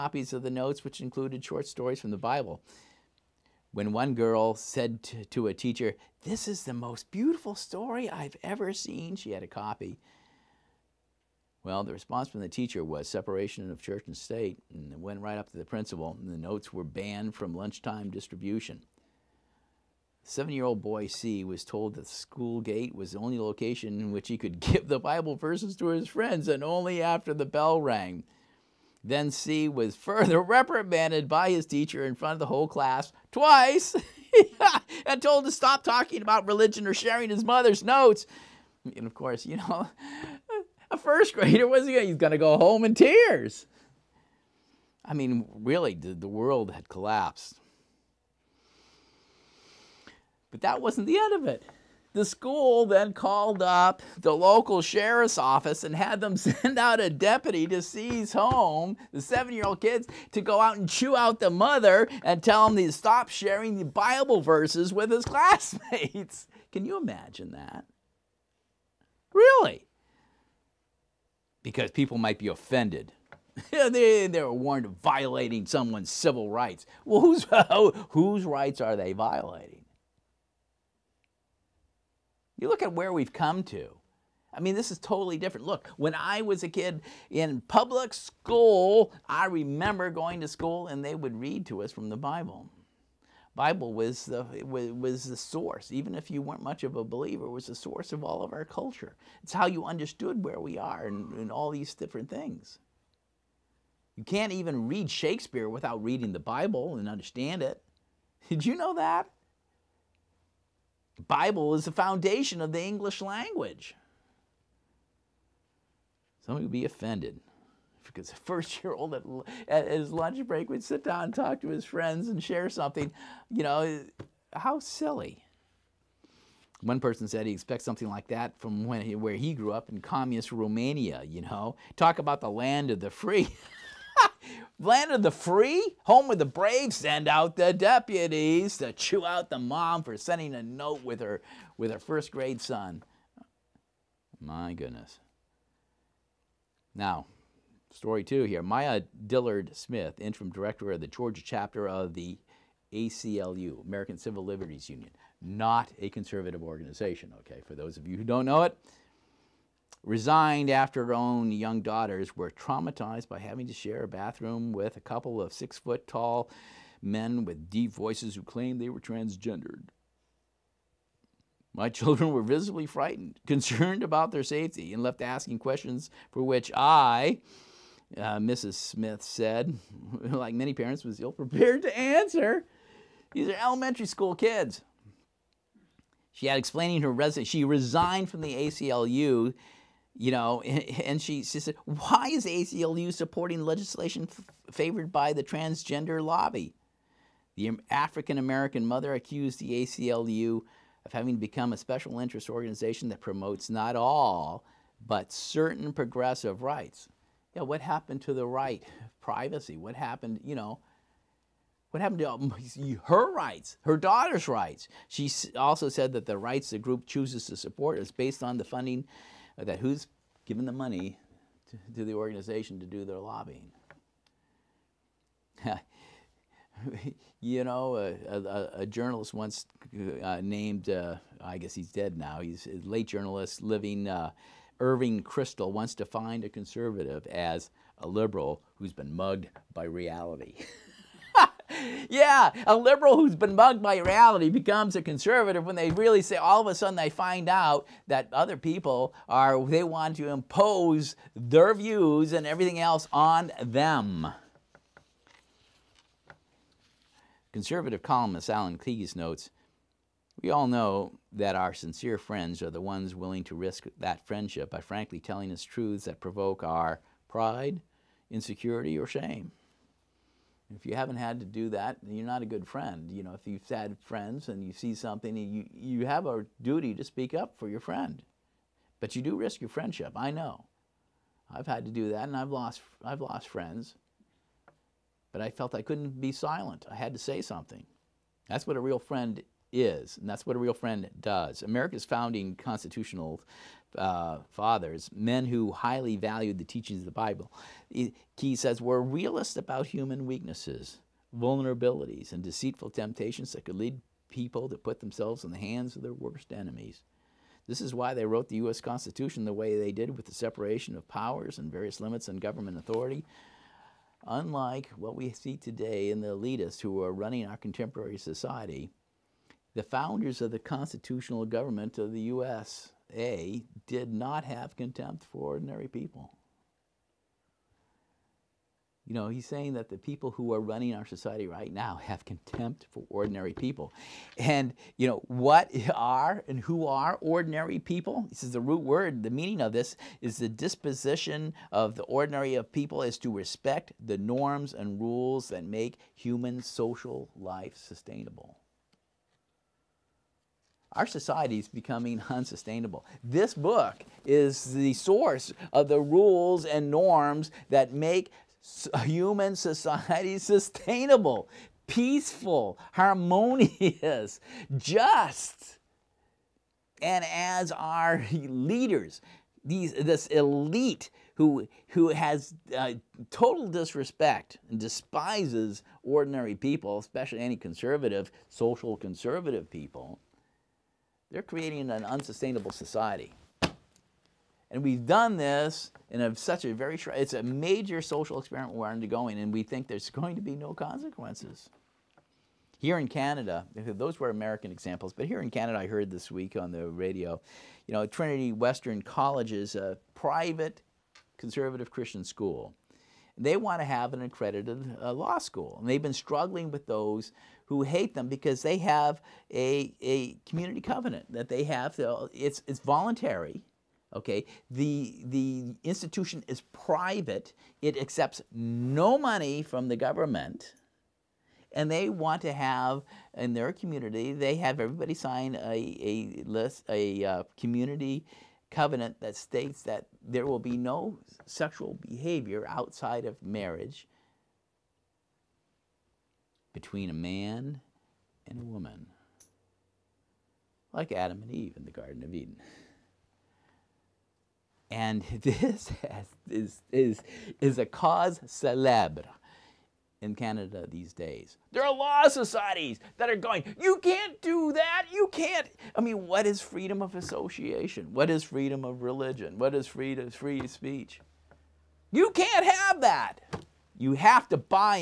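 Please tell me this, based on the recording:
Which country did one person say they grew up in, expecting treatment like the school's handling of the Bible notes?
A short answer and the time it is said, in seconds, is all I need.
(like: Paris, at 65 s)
communist Romania, at 130 s.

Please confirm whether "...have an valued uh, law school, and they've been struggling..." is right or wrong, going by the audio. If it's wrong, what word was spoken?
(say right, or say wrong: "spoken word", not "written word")
wrong: "accredited", not "valued".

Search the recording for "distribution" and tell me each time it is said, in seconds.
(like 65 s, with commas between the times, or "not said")
18 s.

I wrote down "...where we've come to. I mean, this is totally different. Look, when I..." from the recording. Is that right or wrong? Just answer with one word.
right.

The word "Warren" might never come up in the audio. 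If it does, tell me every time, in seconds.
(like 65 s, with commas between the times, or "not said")
not said.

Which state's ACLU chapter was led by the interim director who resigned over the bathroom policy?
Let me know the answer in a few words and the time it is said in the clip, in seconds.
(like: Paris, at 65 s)
Georgia, at 151 s.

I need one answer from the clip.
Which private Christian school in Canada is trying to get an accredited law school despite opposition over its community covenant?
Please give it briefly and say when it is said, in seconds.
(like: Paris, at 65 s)
Trinity Western College, at 398 s.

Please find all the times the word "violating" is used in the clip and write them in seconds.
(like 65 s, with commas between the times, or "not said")
75 s, 79 s.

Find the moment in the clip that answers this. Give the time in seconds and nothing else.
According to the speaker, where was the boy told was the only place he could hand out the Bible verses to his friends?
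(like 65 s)
22 s.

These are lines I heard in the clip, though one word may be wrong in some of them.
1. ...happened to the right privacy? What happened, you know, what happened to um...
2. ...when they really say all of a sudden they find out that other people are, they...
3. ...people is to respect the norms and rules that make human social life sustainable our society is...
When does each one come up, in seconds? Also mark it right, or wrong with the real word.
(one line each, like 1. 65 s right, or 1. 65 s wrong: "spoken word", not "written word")
1. 207 s right
2. 245 s right
3. 342 s right.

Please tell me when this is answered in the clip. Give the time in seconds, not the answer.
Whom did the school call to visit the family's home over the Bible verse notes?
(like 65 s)
54 s.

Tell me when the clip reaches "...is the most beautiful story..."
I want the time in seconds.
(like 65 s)
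6 s.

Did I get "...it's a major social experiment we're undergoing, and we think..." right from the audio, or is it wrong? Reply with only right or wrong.
right.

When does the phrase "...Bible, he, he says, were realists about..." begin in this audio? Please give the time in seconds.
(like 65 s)
297 s.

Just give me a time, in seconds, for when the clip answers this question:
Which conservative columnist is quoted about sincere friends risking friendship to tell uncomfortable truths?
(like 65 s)
258 s.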